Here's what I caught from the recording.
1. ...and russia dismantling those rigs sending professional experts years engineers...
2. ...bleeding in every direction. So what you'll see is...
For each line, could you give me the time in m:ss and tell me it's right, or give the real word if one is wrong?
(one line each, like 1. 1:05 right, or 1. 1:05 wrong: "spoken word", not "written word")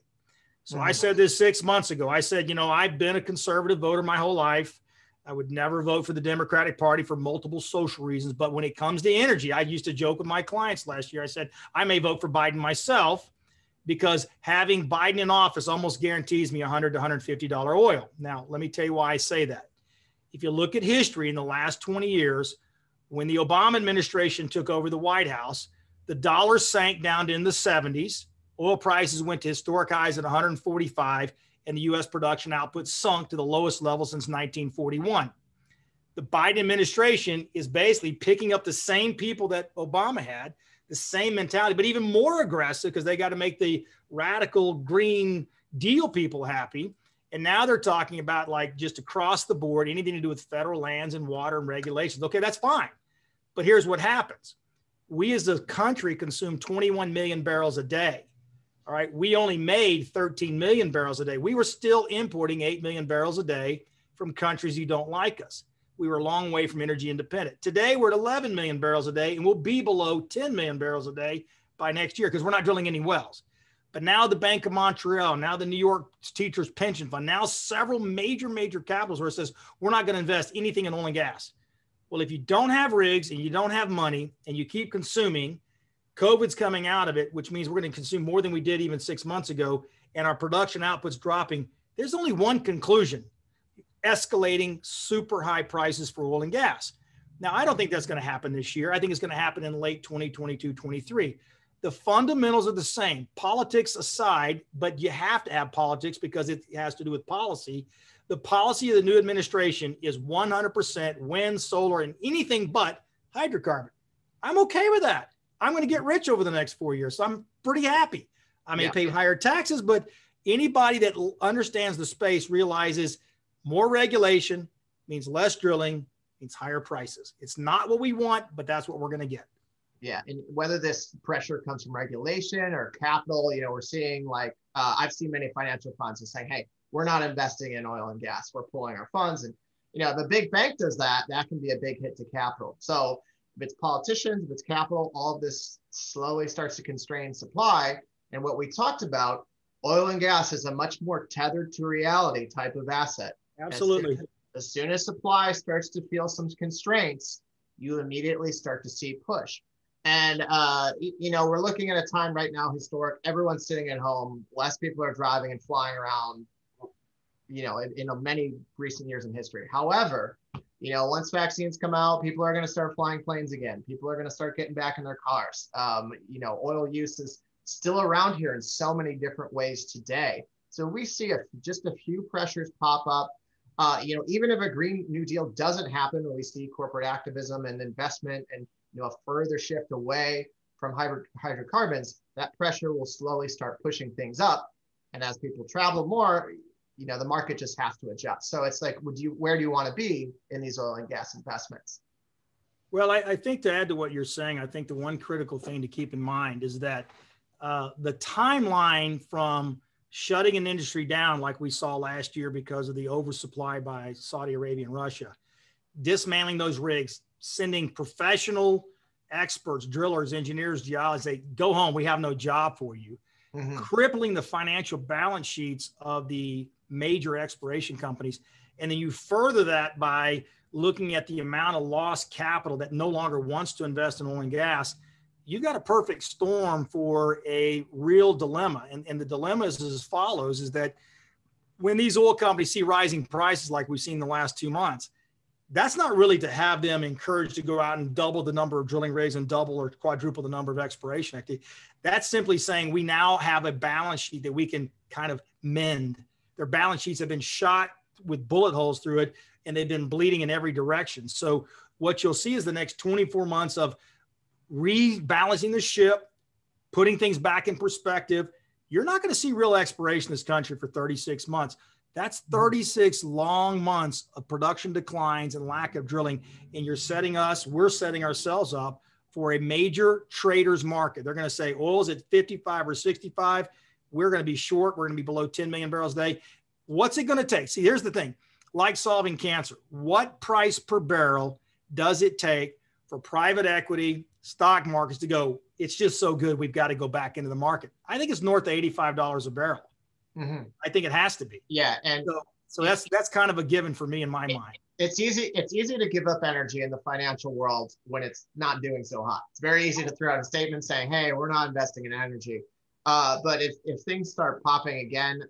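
1. 3:34 wrong: "drillers", not "years"
2. 4:20 right.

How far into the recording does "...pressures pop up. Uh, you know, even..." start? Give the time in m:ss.
3:02.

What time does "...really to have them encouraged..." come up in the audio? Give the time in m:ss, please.
4:06.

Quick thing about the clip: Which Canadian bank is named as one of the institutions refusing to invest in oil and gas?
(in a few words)
Bank of Montreal.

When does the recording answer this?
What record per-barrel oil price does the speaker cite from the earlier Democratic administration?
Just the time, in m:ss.
0:30.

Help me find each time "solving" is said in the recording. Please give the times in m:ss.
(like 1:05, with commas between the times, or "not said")
4:48.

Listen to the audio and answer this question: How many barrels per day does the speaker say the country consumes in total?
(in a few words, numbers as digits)
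21 million.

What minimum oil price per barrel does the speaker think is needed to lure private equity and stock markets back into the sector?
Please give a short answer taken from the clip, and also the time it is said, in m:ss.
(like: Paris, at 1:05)
$85, at 4:58.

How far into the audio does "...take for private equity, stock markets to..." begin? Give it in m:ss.
4:52.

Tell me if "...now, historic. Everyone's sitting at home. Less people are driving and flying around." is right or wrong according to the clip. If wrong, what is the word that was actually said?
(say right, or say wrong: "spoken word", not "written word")
right.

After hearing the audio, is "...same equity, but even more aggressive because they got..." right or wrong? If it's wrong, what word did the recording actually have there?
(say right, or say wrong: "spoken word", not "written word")
wrong: "mentality", not "equity".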